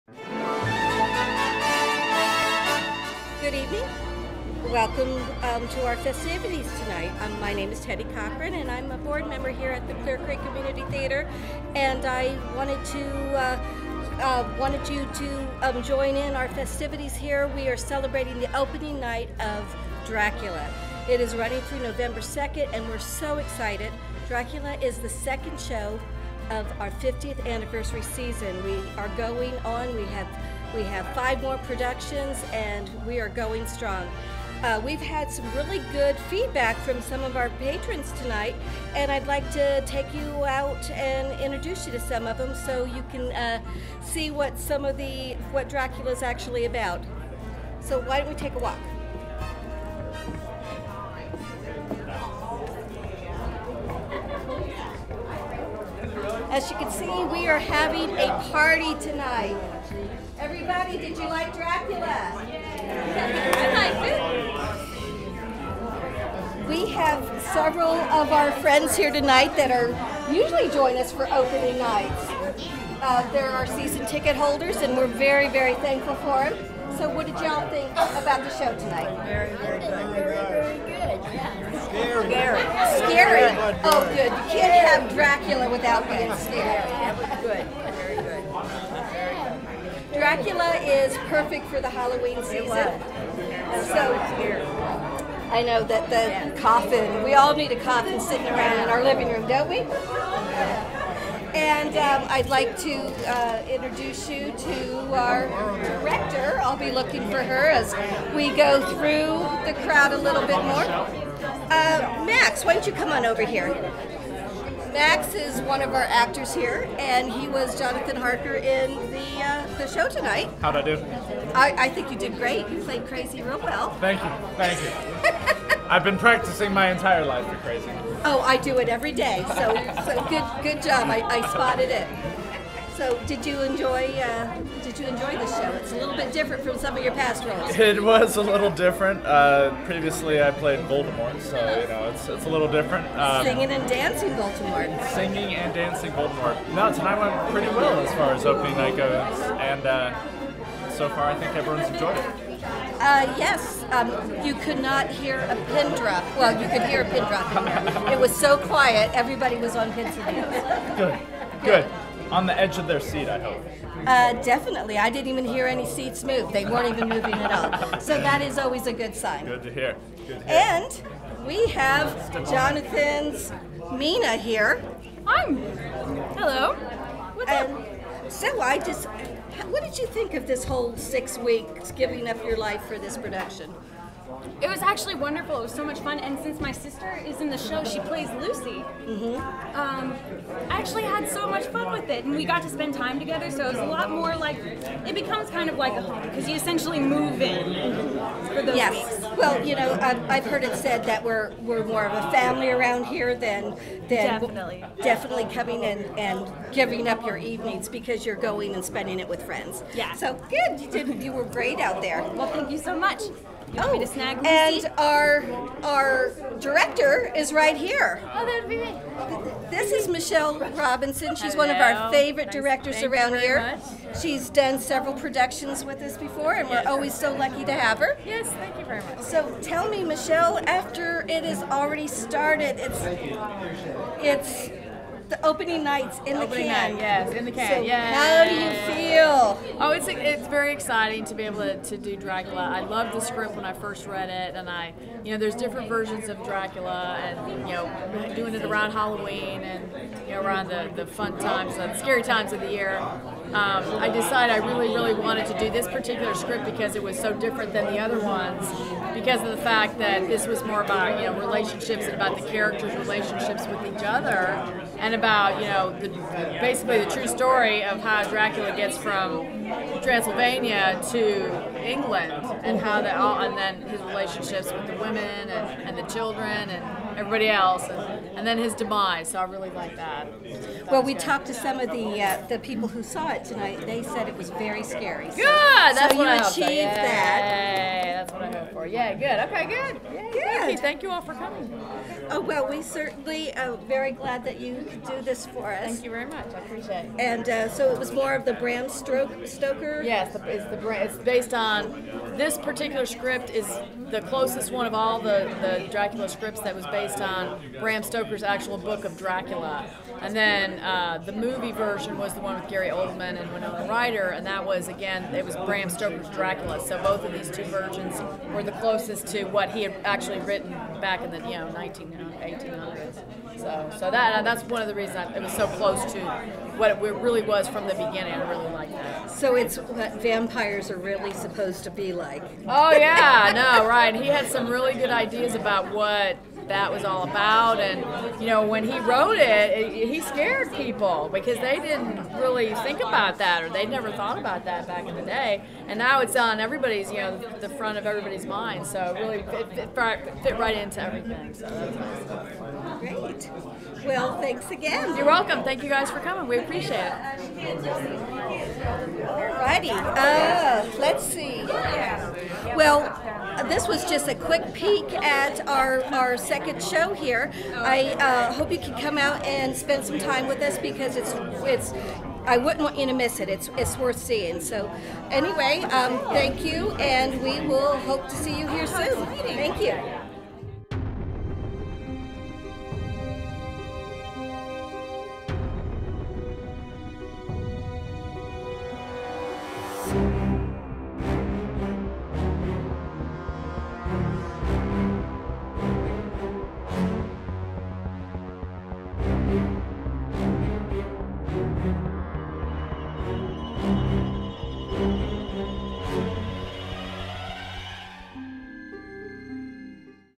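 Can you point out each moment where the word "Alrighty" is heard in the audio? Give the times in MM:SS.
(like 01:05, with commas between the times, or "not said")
05:57.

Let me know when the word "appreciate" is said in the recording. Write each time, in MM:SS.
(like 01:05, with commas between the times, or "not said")
04:56, 05:56.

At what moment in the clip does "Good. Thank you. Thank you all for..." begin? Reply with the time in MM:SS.
04:50.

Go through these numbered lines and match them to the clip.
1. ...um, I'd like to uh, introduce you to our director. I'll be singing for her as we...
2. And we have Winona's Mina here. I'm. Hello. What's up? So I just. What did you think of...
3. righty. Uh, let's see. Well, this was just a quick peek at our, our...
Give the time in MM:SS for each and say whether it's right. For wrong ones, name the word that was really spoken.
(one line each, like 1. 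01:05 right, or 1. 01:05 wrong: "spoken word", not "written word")
1. 01:41 wrong: "looking", not "singing"
2. 02:50 wrong: "Jonathan", not "Winona"
3. 05:59 right.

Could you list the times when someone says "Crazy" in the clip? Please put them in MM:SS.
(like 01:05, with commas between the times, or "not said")
02:03, 02:07.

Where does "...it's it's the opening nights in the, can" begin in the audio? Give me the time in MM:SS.
03:52.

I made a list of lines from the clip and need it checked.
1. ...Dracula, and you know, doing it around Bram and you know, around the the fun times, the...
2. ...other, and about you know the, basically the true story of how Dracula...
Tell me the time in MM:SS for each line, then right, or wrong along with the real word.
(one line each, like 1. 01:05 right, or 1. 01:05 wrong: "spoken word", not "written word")
1. 04:06 wrong: "Halloween", not "Bram"
2. 04:24 right.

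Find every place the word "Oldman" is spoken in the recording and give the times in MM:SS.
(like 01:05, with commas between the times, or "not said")
05:12.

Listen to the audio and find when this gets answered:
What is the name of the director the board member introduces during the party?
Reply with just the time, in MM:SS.
03:40.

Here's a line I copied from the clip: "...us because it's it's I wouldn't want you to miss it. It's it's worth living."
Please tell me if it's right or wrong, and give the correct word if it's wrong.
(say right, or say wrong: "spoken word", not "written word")
wrong: "seeing", not "living".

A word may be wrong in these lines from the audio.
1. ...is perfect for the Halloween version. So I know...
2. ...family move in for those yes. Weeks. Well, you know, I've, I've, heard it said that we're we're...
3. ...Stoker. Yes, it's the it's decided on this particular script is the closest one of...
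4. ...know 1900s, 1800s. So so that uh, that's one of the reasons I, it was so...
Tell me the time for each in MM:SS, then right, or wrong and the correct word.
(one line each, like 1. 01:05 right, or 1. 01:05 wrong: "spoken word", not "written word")
1. 01:30 wrong: "season", not "version"
2. 03:16 wrong: "essentially", not "family"
3. 04:58 wrong: "based", not "decided"
4. 05:21 right.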